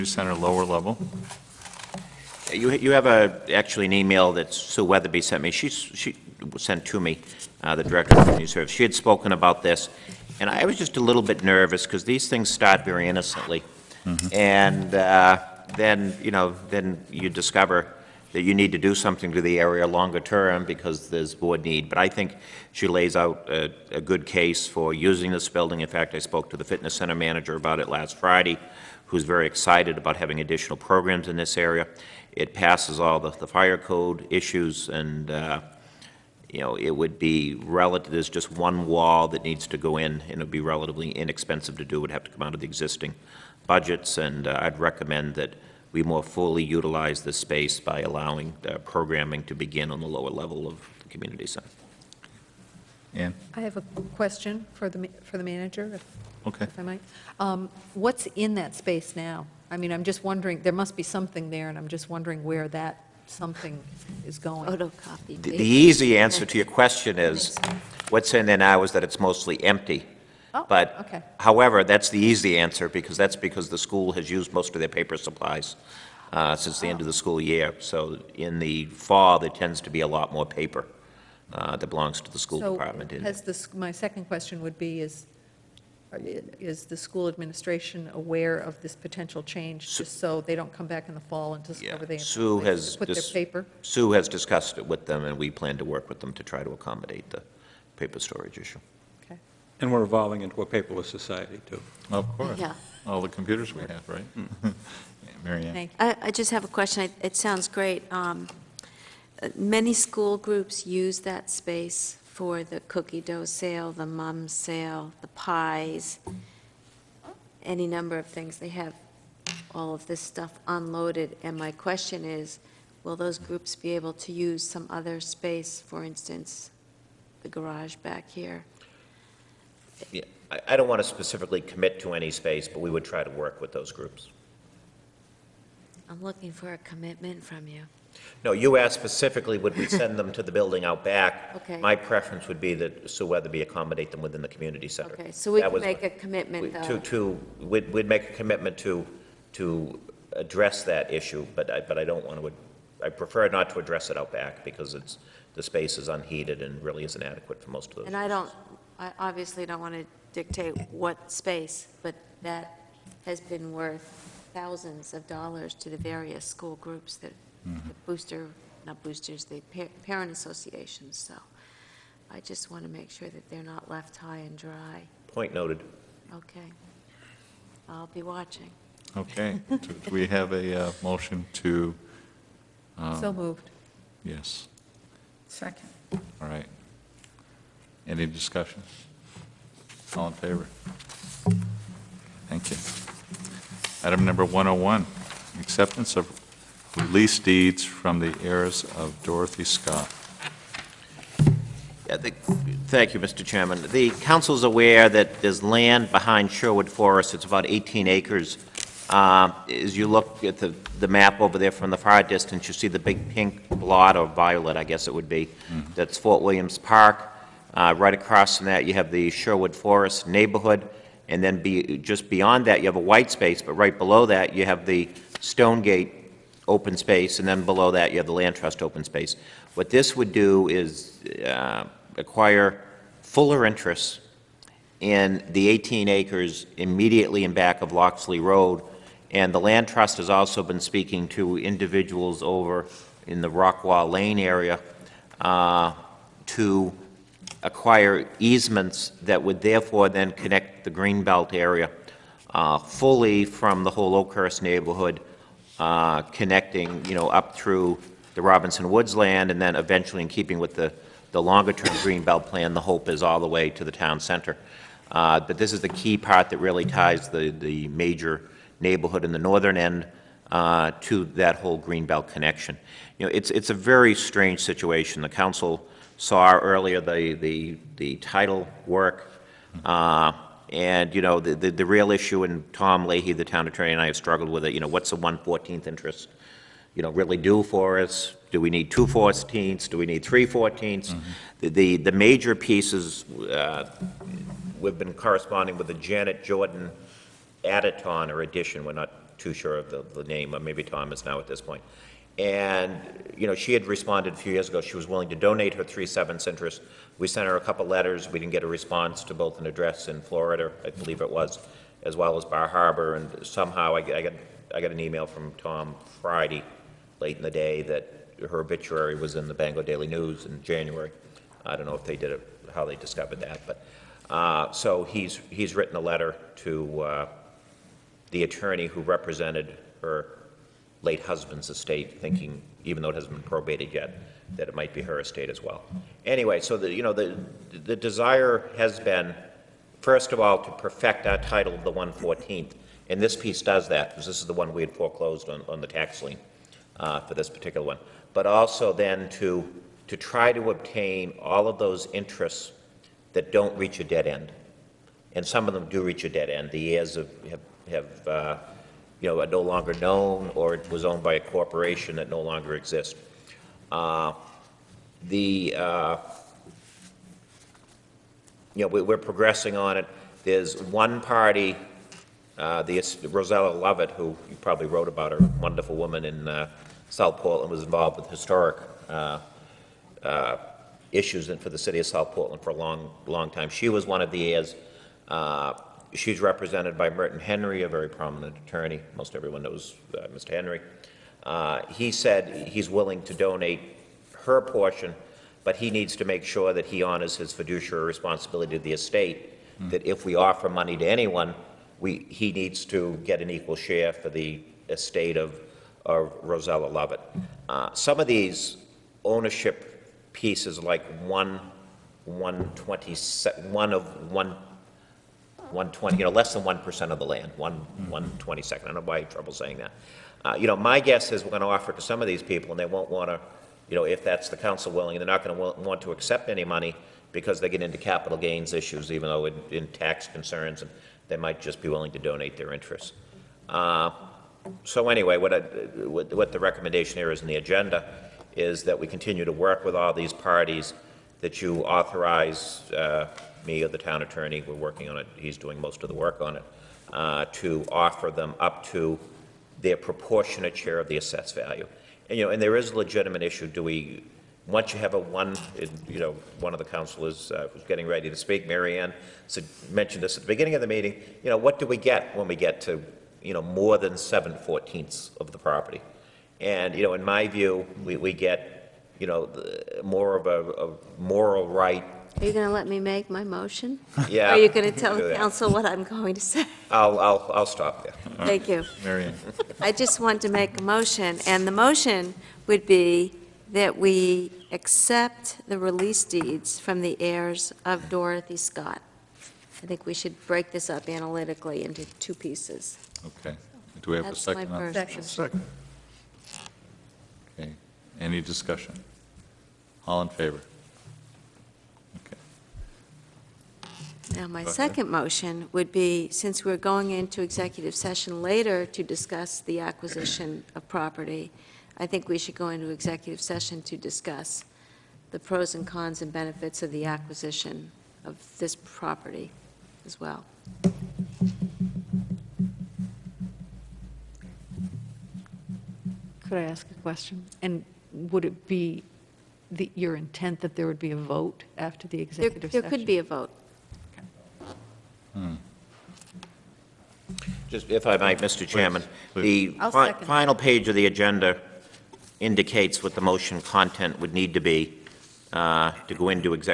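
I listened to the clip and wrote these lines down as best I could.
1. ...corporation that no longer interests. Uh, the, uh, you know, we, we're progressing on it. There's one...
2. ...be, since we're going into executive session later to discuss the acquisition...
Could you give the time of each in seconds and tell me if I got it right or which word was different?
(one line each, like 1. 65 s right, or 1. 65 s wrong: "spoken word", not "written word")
1. 361 s wrong: "exists", not "interests"
2. 505 s right.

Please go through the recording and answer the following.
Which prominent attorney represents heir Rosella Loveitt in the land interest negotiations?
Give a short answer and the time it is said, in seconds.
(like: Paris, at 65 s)
Merton Henry, at 387 s.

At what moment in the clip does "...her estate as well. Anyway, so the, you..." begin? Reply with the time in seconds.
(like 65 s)
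335 s.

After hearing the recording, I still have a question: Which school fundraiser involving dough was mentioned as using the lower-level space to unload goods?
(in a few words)
Cookie dough sale.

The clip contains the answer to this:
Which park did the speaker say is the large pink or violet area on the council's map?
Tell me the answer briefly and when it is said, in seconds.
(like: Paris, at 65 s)
Fort Williams Park, at 216 s.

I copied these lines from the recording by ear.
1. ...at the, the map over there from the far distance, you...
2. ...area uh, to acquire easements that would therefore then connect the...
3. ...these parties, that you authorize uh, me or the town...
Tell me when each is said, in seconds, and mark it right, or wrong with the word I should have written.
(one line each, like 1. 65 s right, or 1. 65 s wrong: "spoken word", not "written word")
1. 210 s right
2. 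244 s right
3. 440 s right.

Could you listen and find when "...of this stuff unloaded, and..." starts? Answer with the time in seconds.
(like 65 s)
119 s.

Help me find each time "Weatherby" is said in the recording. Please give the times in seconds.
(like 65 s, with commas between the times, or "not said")
4 s, 143 s.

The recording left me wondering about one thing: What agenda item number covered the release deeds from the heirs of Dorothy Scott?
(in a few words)
101.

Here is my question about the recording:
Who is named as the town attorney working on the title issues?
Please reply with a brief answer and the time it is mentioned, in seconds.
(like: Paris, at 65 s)
Tom Leahy, at 282 s.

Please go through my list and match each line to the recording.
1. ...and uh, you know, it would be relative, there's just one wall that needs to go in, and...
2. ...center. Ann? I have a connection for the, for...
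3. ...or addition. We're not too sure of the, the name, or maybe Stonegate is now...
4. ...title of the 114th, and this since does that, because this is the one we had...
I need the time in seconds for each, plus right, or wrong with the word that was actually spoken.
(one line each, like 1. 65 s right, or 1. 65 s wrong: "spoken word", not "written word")
1. 34 s right
2. 51 s wrong: "question", not "connection"
3. 298 s wrong: "Tom", not "Stonegate"
4. 341 s wrong: "piece", not "since".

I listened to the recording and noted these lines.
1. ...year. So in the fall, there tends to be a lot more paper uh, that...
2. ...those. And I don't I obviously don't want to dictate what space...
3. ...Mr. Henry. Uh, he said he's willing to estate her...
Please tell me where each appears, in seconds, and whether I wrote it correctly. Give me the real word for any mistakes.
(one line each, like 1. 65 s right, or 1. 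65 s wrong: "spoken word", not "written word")
1. 77 s right
2. 157 s right
3. 390 s wrong: "donate", not "estate".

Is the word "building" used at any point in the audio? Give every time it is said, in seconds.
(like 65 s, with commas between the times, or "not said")
25 s, 140 s.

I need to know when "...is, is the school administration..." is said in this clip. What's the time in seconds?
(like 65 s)
85 s.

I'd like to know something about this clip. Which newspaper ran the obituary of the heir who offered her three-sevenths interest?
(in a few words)
Bangor Daily News.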